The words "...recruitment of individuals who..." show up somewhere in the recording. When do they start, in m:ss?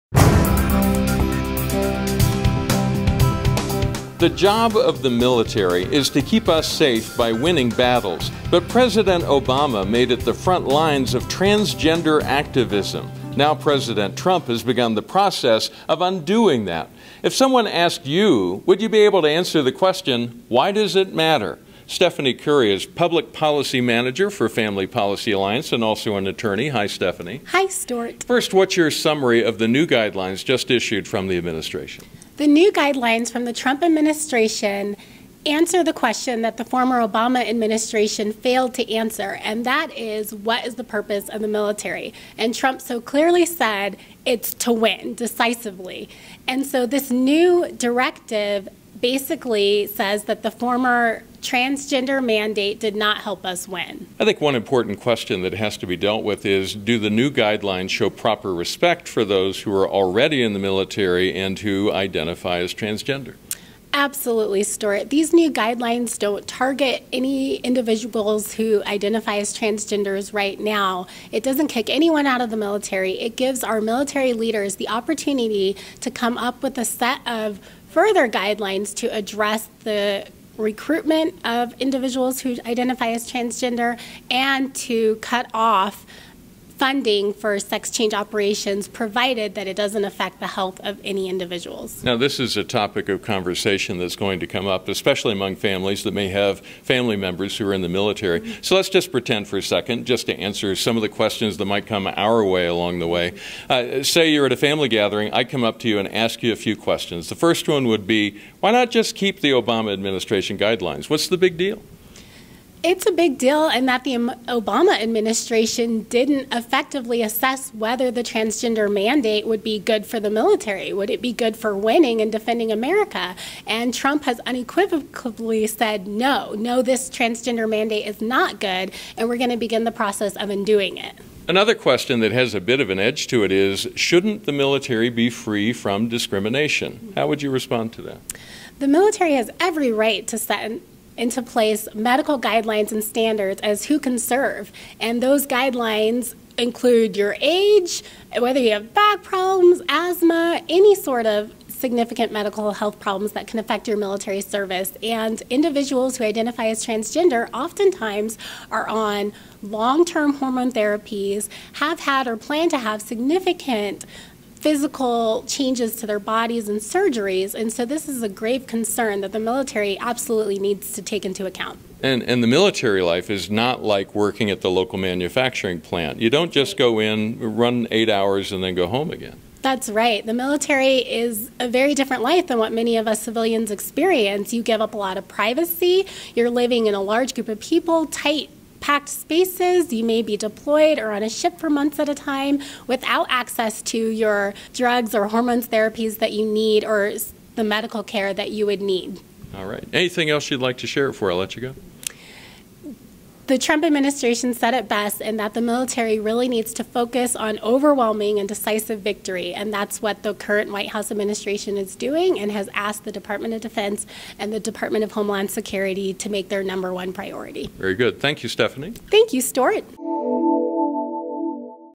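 1:20.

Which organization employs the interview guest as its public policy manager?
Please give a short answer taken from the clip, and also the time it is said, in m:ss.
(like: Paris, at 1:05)
Family Policy Alliance, at 0:24.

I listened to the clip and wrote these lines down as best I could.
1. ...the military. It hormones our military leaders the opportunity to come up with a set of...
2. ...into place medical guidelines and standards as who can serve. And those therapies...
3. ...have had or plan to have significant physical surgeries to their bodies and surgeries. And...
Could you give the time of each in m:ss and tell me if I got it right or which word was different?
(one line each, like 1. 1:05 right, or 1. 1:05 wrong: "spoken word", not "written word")
1. 1:12 wrong: "gives", not "hormones"
2. 2:21 wrong: "guidelines", not "therapies"
3. 2:41 wrong: "changes", not "surgeries".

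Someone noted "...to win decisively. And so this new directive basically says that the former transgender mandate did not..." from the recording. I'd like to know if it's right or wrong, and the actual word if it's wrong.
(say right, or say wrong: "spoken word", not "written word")
right.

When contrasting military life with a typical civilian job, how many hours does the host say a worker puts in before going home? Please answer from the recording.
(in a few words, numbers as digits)
8.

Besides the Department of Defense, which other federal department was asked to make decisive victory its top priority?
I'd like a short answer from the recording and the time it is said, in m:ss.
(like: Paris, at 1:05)
Department of Homeland Security, at 3:34.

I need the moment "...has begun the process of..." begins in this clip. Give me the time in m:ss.
0:14.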